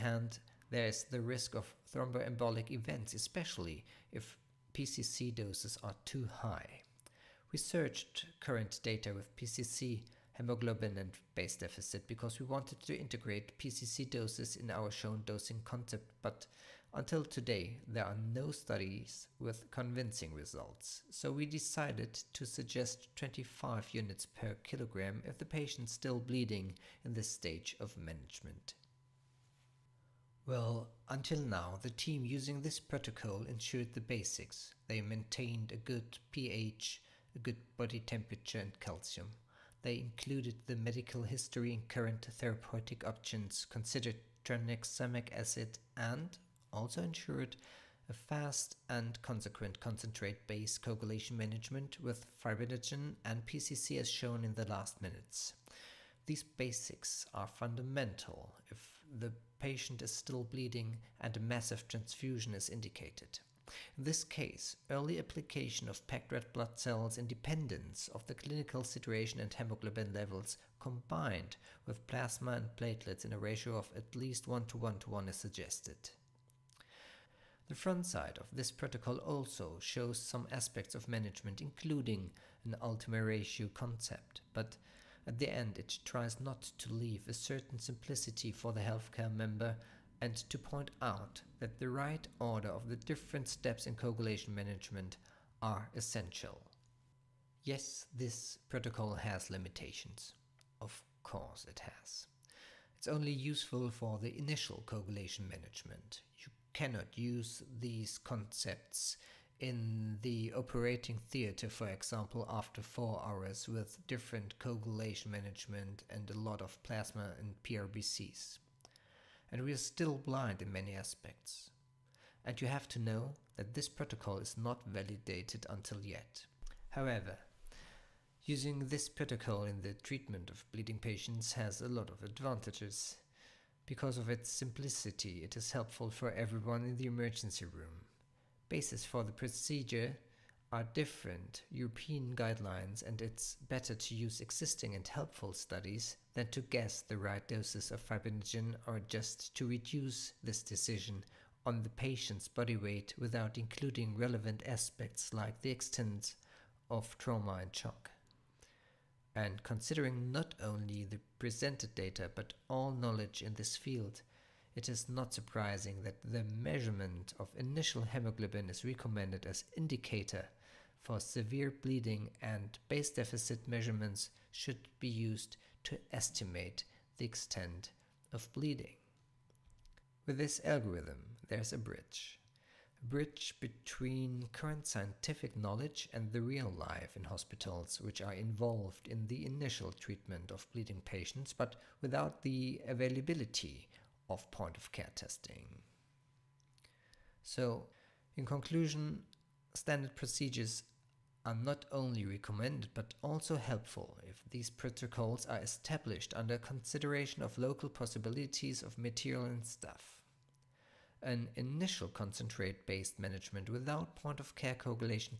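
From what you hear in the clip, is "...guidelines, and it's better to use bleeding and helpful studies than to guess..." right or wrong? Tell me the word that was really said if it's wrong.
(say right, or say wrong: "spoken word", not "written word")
wrong: "existing", not "bleeding".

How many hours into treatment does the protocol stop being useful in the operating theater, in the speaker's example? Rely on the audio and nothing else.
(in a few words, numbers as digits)
4.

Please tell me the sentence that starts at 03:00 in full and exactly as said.
With this algorithm, there's a bridge.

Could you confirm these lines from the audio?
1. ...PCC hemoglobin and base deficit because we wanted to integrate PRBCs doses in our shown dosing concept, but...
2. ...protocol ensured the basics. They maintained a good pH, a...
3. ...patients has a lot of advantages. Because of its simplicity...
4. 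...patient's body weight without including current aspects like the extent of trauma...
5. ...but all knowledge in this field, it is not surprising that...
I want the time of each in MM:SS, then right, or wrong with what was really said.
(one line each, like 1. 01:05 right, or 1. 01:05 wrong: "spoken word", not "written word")
1. 00:09 wrong: "PCC", not "PRBCs"
2. 00:32 right
3. 02:10 right
4. 02:31 wrong: "relevant", not "current"
5. 02:42 right.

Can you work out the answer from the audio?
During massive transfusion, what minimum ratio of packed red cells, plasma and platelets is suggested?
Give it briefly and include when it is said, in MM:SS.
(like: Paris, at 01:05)
1 to 1 to 1, at 01:14.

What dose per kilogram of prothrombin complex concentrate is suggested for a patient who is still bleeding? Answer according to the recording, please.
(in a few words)
25 units per kilogram.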